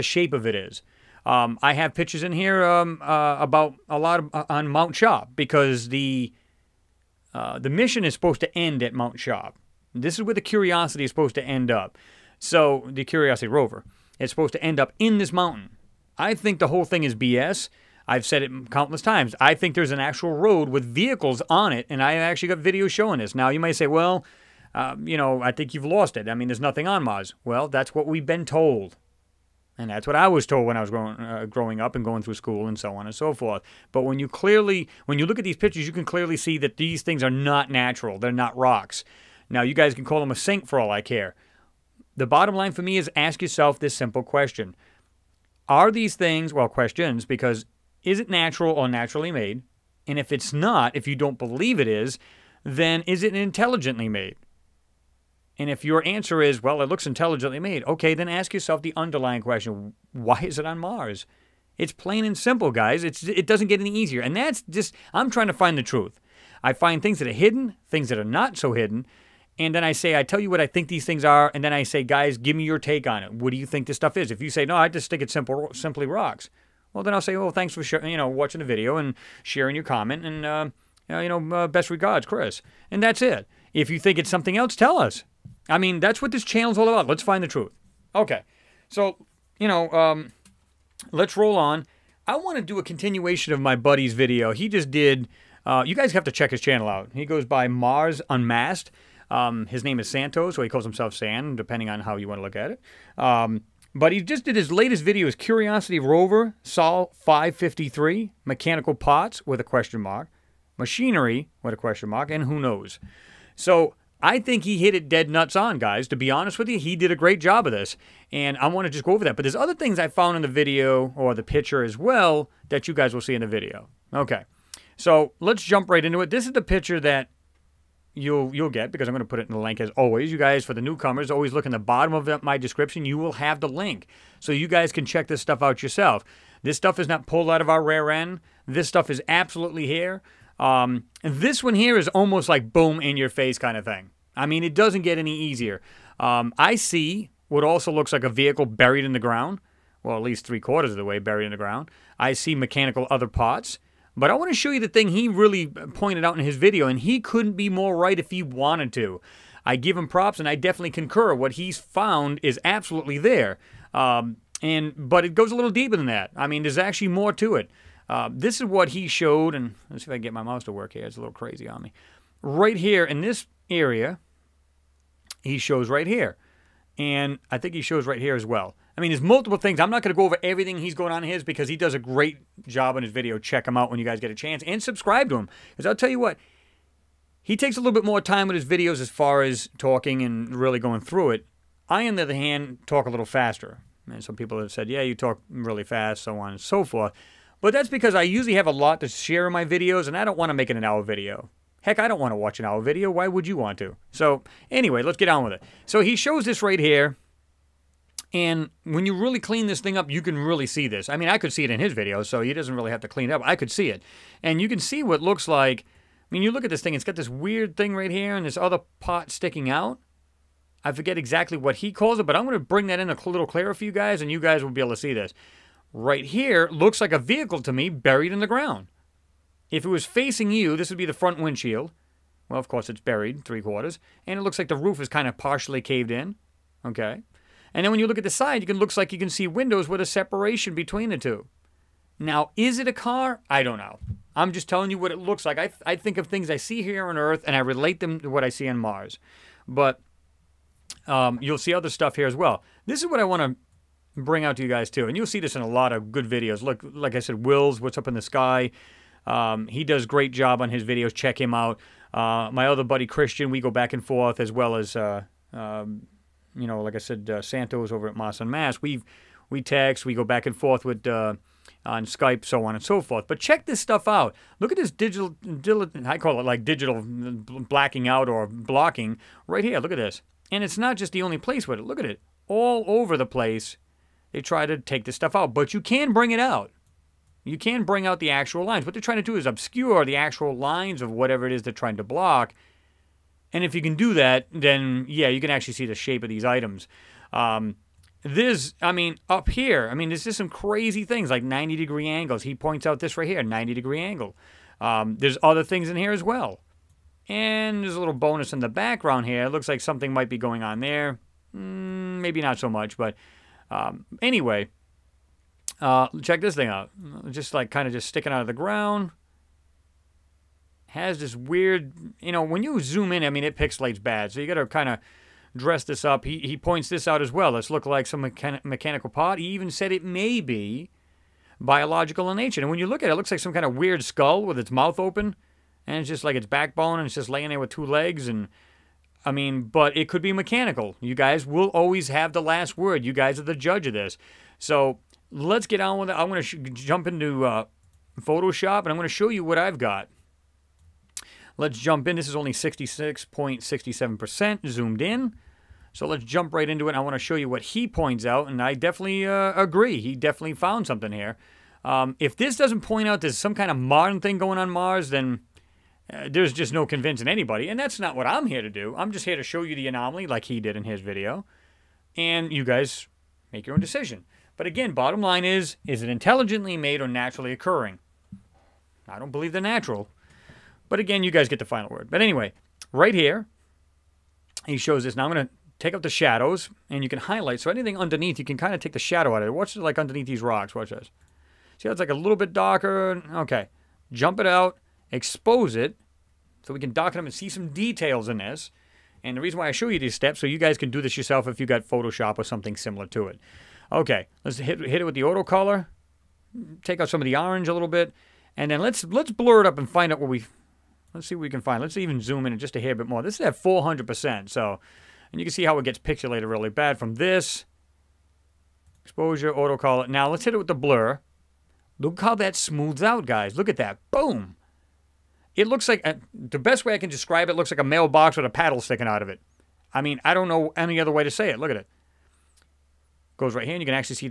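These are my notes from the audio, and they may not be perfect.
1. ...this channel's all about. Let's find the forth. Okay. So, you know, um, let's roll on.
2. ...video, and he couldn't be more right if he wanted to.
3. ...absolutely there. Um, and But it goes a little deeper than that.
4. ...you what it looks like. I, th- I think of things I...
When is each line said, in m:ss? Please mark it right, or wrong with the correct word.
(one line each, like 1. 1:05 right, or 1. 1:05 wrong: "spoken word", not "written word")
1. 1:26 wrong: "truth", not "forth"
2. 2:36 right
3. 2:42 right
4. 4:04 right.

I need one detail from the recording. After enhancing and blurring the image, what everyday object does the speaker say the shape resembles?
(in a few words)
A mailbox.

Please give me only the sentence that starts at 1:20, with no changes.
And, uh, uh, you know, uh, best regards, Chris.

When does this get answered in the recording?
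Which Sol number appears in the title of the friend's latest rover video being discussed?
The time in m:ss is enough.
1:46.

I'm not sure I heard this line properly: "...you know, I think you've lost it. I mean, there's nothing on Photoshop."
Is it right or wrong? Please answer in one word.
wrong.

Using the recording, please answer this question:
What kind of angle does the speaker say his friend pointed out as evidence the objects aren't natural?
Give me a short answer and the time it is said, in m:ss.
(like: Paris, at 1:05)
90 degree angle, at 5:03.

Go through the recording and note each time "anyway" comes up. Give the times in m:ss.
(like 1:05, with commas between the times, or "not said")
3:24, 5:14, 6:22.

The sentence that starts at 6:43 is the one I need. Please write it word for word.
Okay, let's hit, hit it with the auto color.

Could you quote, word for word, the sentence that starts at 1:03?
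It's, it doesn't get any easier.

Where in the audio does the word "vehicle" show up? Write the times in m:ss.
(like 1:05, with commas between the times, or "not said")
0:20, 2:28, 3:47.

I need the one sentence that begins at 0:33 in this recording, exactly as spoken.
But when you clearly, when you look at these pictures, you can clearly see that these things are not natural.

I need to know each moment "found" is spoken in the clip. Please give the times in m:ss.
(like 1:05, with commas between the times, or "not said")
2:00, 2:41, 6:00.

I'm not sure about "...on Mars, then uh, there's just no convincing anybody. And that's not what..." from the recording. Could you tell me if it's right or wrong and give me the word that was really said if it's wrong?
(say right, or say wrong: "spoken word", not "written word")
right.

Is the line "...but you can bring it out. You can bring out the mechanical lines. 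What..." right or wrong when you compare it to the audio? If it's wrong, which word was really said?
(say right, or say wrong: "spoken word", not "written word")
wrong: "actual", not "mechanical".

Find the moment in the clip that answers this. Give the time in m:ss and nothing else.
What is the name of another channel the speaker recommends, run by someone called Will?
4:17.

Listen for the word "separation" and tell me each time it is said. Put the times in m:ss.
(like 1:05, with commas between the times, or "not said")
4:00.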